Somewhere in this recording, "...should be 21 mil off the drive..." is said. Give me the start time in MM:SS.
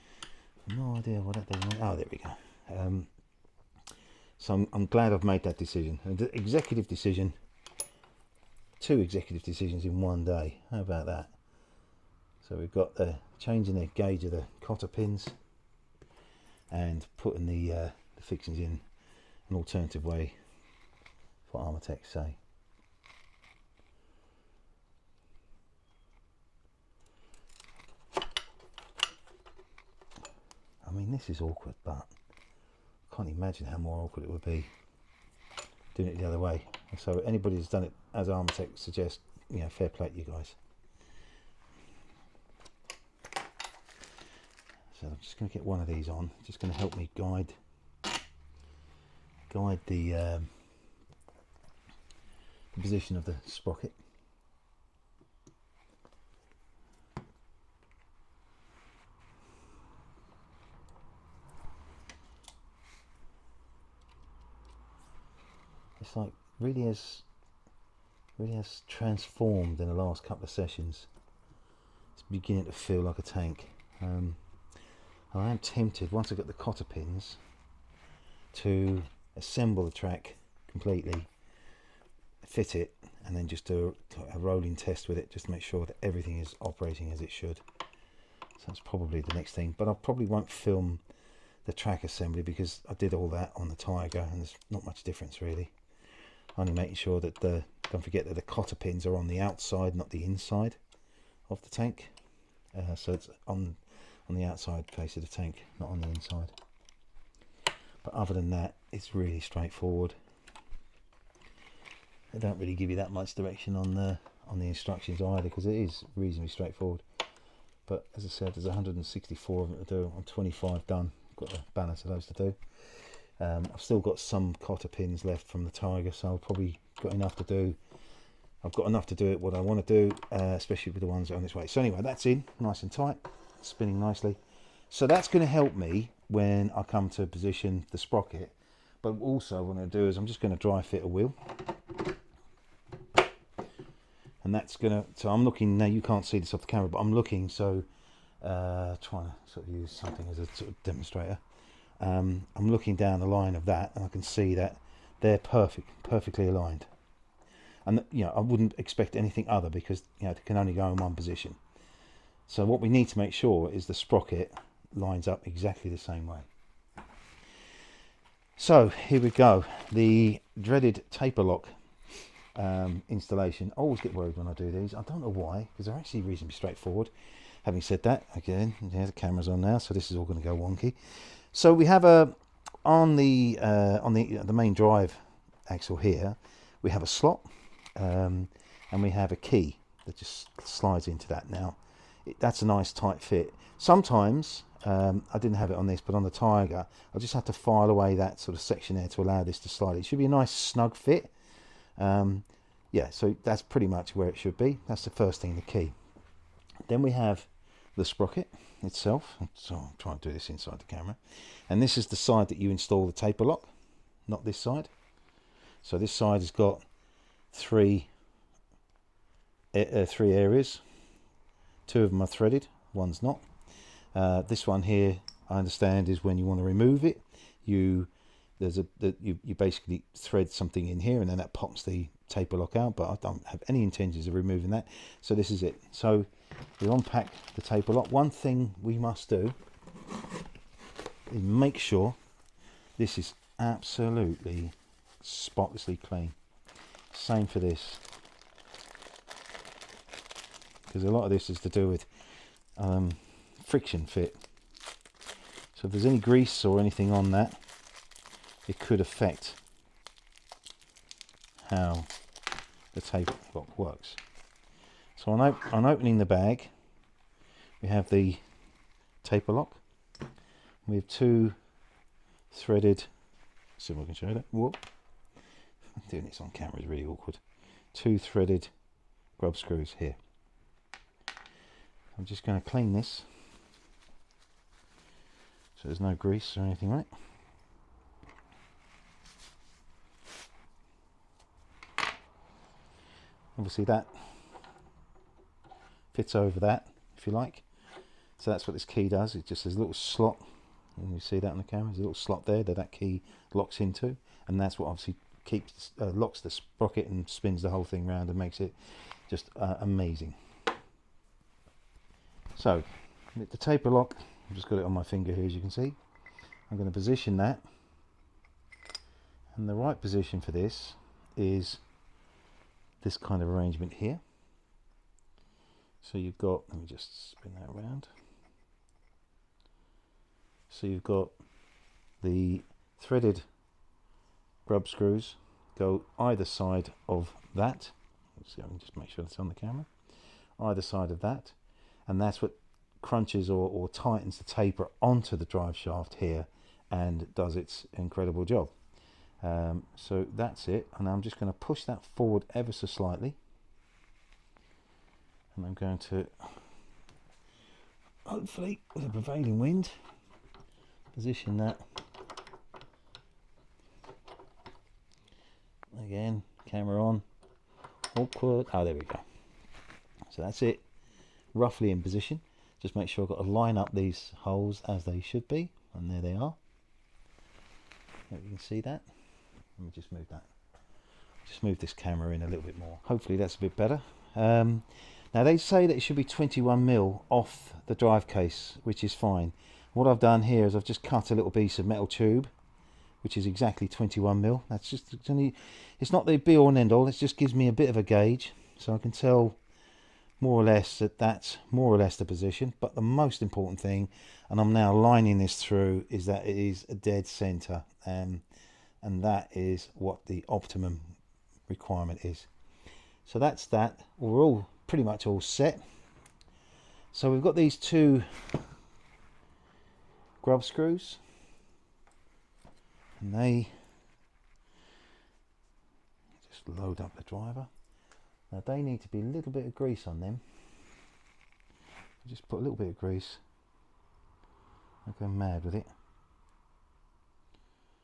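06:26.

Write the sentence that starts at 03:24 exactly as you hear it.
That's the first thing, the key.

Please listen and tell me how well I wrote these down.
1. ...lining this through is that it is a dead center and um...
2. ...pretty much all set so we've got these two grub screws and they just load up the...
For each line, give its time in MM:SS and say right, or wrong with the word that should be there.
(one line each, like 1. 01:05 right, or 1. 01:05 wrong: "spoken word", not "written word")
1. 06:44 right
2. 06:54 right.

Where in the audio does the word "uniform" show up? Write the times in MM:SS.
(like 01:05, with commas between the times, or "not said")
not said.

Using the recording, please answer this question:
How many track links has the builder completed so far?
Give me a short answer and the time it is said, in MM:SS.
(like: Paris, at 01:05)
25, at 02:00.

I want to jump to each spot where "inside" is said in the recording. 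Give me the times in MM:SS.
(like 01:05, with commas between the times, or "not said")
01:40, 01:46, 03:30.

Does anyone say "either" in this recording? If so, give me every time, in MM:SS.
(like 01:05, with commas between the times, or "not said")
01:55, 05:36, 05:40.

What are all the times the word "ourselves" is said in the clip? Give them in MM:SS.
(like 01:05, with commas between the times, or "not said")
not said.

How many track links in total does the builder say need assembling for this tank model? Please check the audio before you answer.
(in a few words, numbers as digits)
164.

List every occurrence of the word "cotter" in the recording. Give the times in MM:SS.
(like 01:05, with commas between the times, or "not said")
00:14, 01:16, 01:38, 02:04.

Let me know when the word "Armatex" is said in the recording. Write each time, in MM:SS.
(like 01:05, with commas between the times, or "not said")
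00:21, 00:38.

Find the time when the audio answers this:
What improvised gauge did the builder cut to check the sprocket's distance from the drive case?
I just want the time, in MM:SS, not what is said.
06:31.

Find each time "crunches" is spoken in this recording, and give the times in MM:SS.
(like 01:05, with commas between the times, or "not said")
05:43.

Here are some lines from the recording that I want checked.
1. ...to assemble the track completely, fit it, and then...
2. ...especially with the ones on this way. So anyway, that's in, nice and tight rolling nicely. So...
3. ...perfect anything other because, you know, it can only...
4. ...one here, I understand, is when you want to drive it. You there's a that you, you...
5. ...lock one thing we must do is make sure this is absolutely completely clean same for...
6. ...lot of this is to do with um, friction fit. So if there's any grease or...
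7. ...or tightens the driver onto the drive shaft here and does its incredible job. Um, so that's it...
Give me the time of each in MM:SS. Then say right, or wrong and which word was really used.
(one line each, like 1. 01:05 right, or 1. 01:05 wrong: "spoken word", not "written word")
1. 01:18 right
2. 02:10 wrong: "spinning", not "rolling"
3. 02:38 wrong: "expect", not "perfect"
4. 03:44 wrong: "remove", not "drive"
5. 03:57 wrong: "spotlessly", not "completely"
6. 04:11 right
7. 05:43 wrong: "taper", not "driver".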